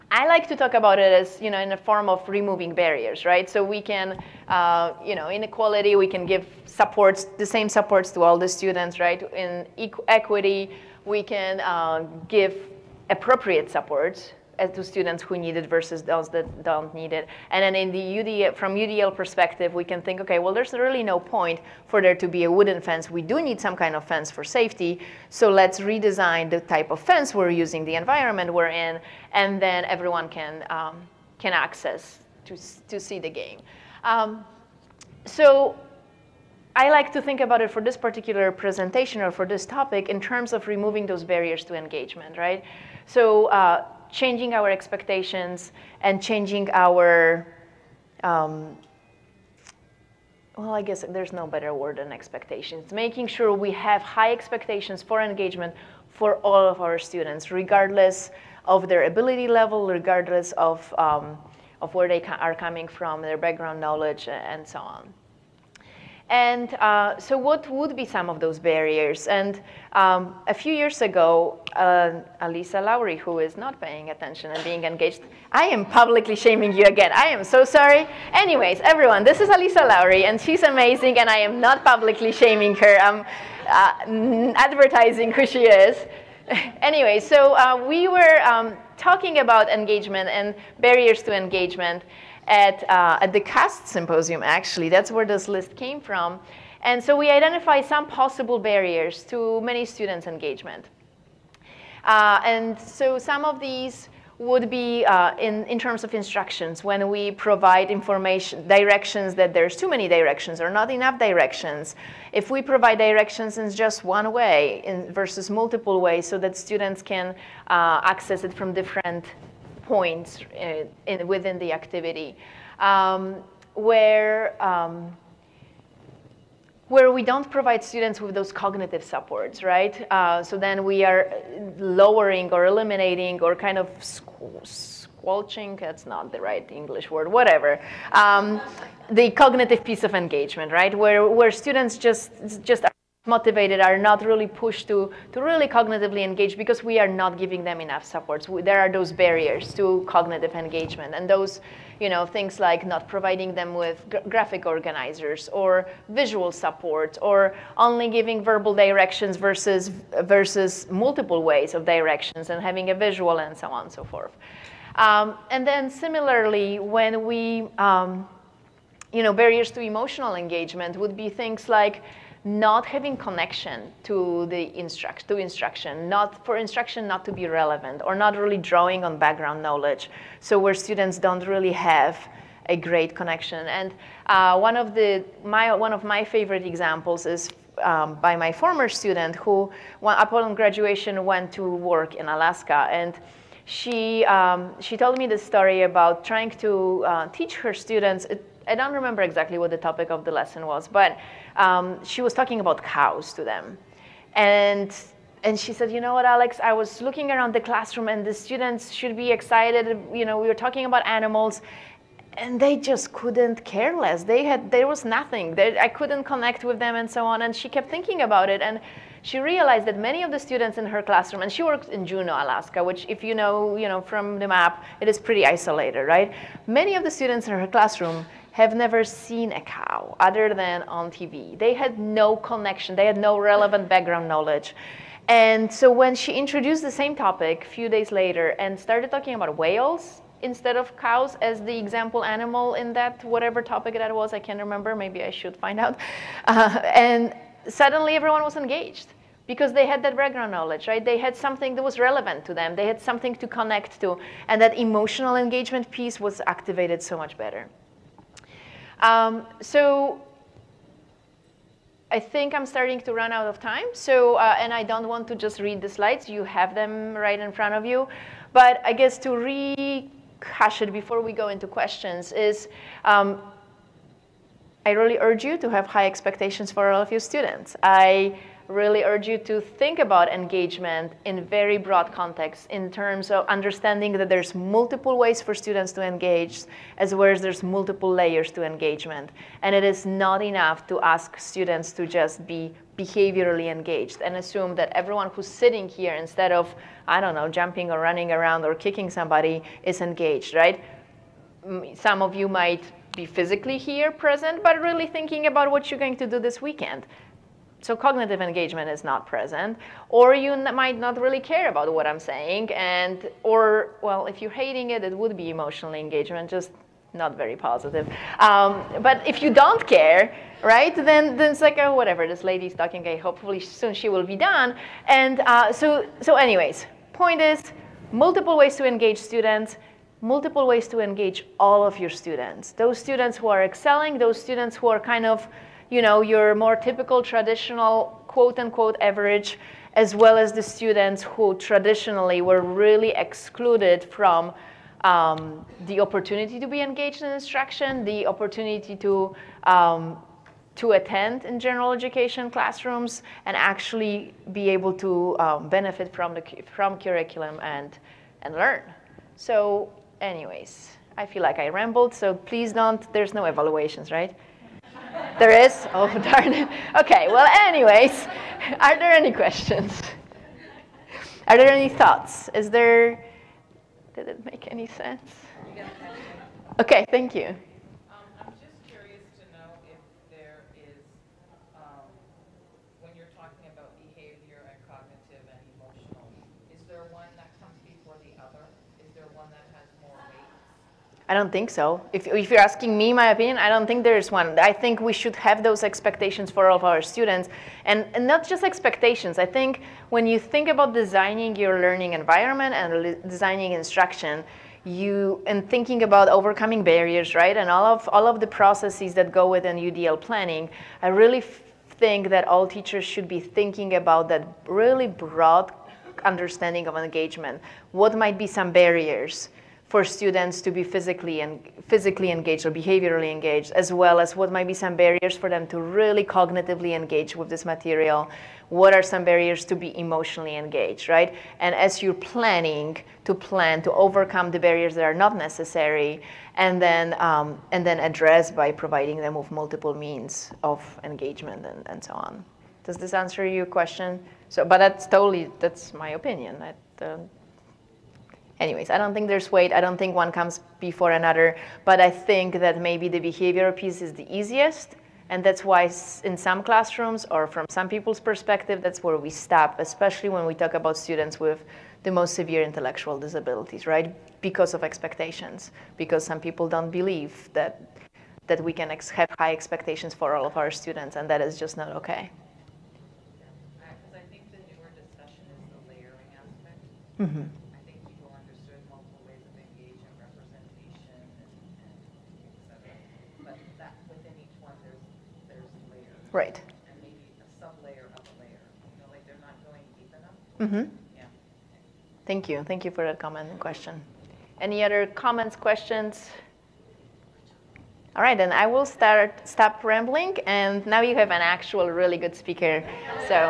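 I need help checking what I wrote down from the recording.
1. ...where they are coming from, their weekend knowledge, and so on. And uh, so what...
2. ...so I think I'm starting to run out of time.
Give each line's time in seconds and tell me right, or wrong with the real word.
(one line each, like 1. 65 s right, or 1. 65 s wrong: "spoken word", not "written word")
1. 61 s wrong: "background", not "weekend"
2. 259 s right.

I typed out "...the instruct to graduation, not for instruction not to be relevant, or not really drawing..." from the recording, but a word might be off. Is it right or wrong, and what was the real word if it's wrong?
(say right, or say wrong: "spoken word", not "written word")
wrong: "instruction", not "graduation".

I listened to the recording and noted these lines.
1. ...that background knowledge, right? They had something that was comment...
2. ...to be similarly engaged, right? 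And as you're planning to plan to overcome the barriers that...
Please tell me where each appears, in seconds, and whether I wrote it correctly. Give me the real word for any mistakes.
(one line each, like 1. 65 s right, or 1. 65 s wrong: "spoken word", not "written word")
1. 250 s wrong: "relevant", not "comment"
2. 429 s wrong: "emotionally", not "similarly".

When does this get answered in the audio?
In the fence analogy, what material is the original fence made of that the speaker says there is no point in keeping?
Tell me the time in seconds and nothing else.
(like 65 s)
22 s.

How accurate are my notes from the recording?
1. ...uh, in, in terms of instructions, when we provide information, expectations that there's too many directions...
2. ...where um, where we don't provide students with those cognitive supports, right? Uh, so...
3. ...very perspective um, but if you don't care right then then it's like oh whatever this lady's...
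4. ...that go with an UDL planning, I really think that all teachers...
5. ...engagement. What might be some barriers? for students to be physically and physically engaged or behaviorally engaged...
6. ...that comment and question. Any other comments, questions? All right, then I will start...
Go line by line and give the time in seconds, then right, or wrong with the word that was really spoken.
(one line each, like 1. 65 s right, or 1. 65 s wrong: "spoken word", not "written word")
1. 105 s wrong: "directions", not "expectations"
2. 123 s right
3. 317 s wrong: "positive", not "perspective"
4. 409 s right
5. 416 s right
6. 493 s right.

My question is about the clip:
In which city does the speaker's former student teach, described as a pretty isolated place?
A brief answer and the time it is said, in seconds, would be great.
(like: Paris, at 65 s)
Juneau, Alaska, at 222 s.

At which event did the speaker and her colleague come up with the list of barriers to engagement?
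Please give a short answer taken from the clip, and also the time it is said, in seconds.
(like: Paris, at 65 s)
CAST symposium, at 93 s.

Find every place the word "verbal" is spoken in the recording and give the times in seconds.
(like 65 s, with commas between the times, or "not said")
158 s.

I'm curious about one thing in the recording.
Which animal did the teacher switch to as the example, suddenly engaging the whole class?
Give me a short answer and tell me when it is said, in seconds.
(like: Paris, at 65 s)
whales, at 239 s.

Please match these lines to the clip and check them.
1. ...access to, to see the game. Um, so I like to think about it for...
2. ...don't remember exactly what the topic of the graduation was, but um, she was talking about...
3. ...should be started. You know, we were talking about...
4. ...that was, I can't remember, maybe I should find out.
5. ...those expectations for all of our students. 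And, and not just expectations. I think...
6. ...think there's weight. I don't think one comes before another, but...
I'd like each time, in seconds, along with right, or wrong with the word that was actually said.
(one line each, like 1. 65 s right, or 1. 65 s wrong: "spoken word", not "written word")
1. 31 s right
2. 198 s wrong: "lesson", not "graduation"
3. 208 s wrong: "excited", not "started"
4. 243 s right
5. 395 s right
6. 449 s right.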